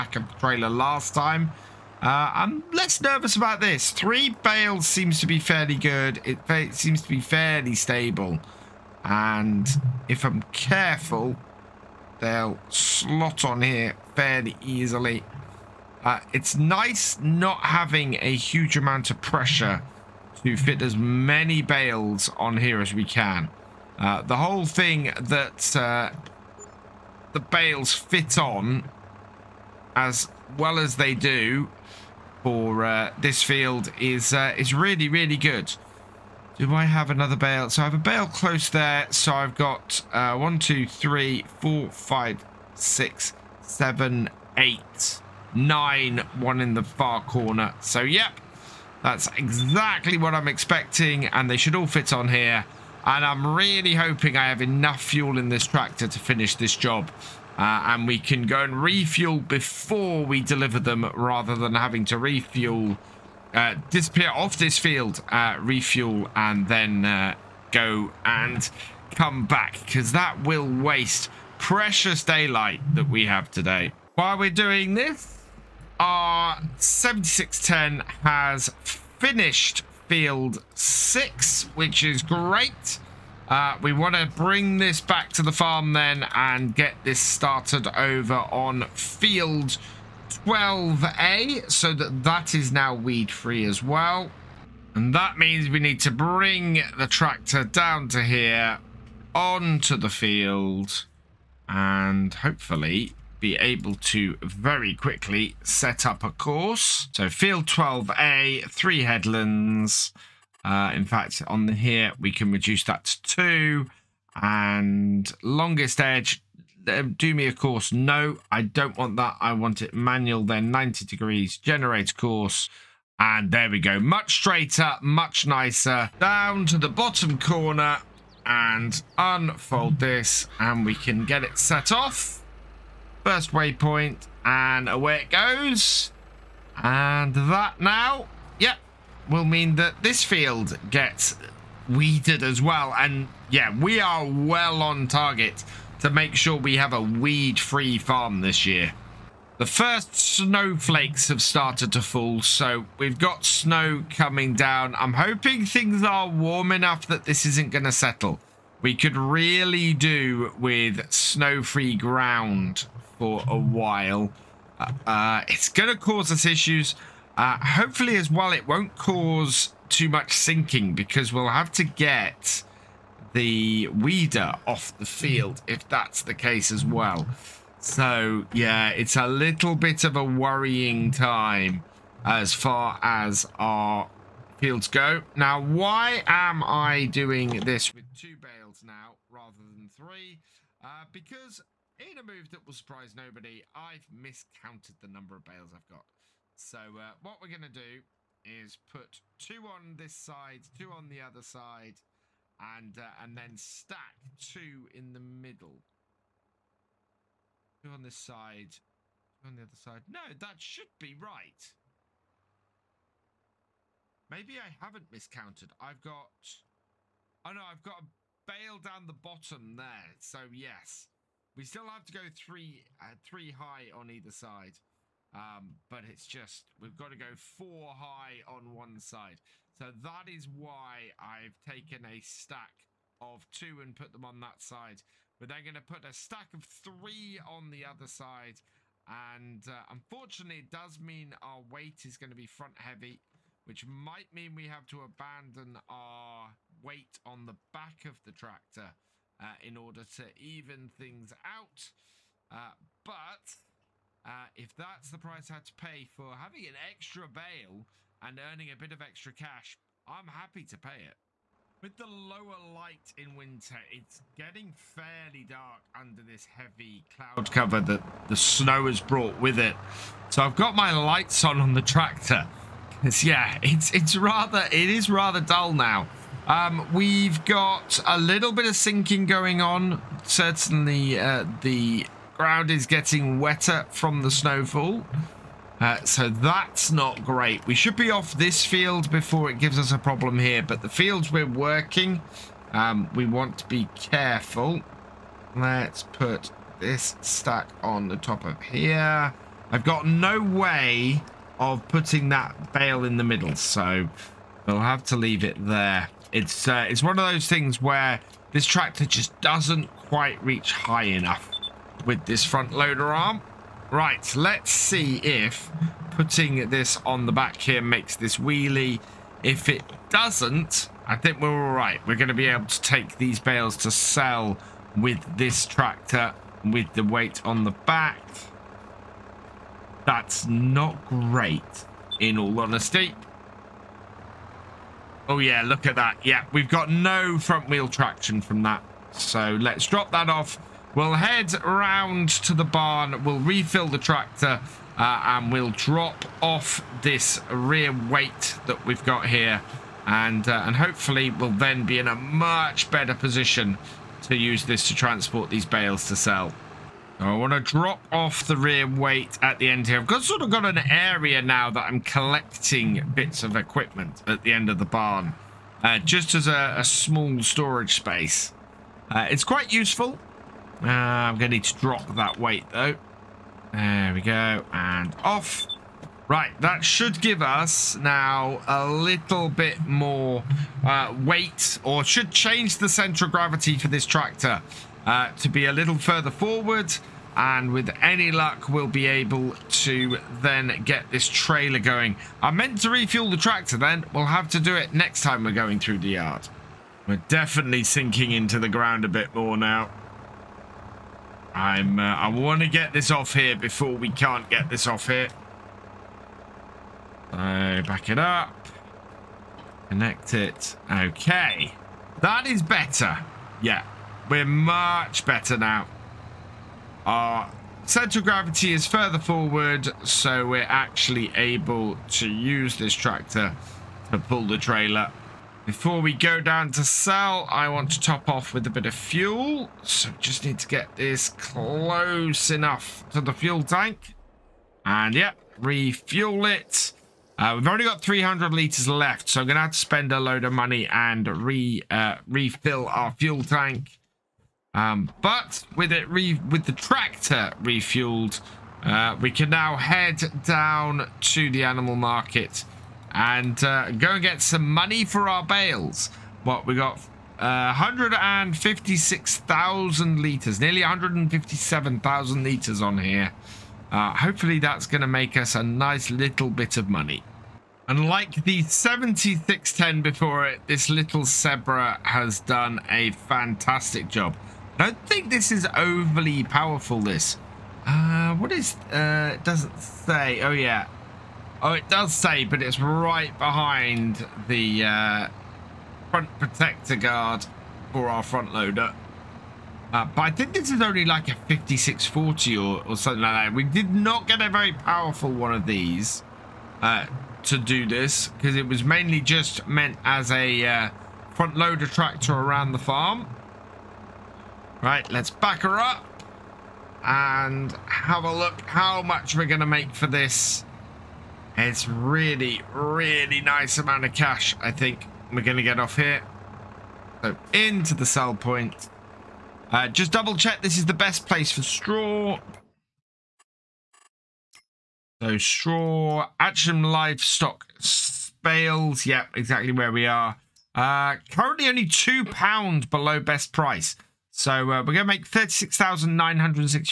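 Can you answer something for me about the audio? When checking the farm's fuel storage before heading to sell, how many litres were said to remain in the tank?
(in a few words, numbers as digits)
300 litres.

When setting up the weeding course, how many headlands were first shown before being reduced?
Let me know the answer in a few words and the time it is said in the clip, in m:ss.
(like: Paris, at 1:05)
3, at 1:48.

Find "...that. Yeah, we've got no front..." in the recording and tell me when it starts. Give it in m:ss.
5:35.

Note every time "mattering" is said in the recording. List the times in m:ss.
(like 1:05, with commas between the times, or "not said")
not said.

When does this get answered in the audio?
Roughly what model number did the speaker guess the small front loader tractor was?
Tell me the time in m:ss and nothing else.
8:11.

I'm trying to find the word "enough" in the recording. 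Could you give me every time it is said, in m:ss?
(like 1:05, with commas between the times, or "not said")
0:54, 2:36, 5:11, 7:12.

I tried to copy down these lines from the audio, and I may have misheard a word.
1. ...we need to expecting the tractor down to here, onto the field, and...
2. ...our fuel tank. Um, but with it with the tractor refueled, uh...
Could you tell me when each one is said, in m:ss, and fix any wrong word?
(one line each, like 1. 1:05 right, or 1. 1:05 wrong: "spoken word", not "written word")
1. 1:35 wrong: "bring", not "expecting"
2. 7:22 right.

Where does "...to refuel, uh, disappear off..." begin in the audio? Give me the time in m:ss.
1:02.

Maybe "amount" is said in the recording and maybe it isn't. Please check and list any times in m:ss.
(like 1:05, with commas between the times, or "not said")
0:18, 8:33.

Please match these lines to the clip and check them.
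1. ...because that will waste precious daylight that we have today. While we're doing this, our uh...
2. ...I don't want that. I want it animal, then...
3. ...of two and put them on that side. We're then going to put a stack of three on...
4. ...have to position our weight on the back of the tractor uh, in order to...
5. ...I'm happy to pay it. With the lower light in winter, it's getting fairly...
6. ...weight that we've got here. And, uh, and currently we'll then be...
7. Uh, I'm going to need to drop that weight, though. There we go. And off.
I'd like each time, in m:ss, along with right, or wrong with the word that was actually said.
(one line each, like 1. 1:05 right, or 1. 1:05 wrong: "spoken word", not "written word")
1. 1:09 right
2. 1:58 wrong: "manual", not "animal"
3. 3:53 right
4. 4:04 wrong: "abandon", not "position"
5. 4:20 right
6. 5:47 wrong: "hopefully", not "currently"
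7. 6:10 right.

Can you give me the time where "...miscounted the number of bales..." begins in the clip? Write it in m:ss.
3:14.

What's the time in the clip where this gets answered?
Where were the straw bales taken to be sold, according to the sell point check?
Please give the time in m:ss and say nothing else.
8:46.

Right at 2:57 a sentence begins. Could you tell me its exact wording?
So, yeah, it's a little bit of a worrying time as far as our fields go.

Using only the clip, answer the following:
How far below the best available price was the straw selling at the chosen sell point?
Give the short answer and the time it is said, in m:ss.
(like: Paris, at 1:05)
£2, at 8:51.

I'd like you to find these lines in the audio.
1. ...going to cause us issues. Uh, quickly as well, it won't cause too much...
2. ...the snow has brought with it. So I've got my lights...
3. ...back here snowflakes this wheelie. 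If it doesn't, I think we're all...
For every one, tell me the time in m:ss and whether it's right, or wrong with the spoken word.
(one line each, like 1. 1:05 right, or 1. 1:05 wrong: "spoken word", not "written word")
1. 2:45 wrong: "hopefully", not "quickly"
2. 4:28 right
3. 5:17 wrong: "makes", not "snowflakes".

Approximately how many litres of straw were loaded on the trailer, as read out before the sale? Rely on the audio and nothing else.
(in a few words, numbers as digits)
Nearly 157,000 litres.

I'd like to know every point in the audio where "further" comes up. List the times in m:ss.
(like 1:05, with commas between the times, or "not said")
6:25, 6:58.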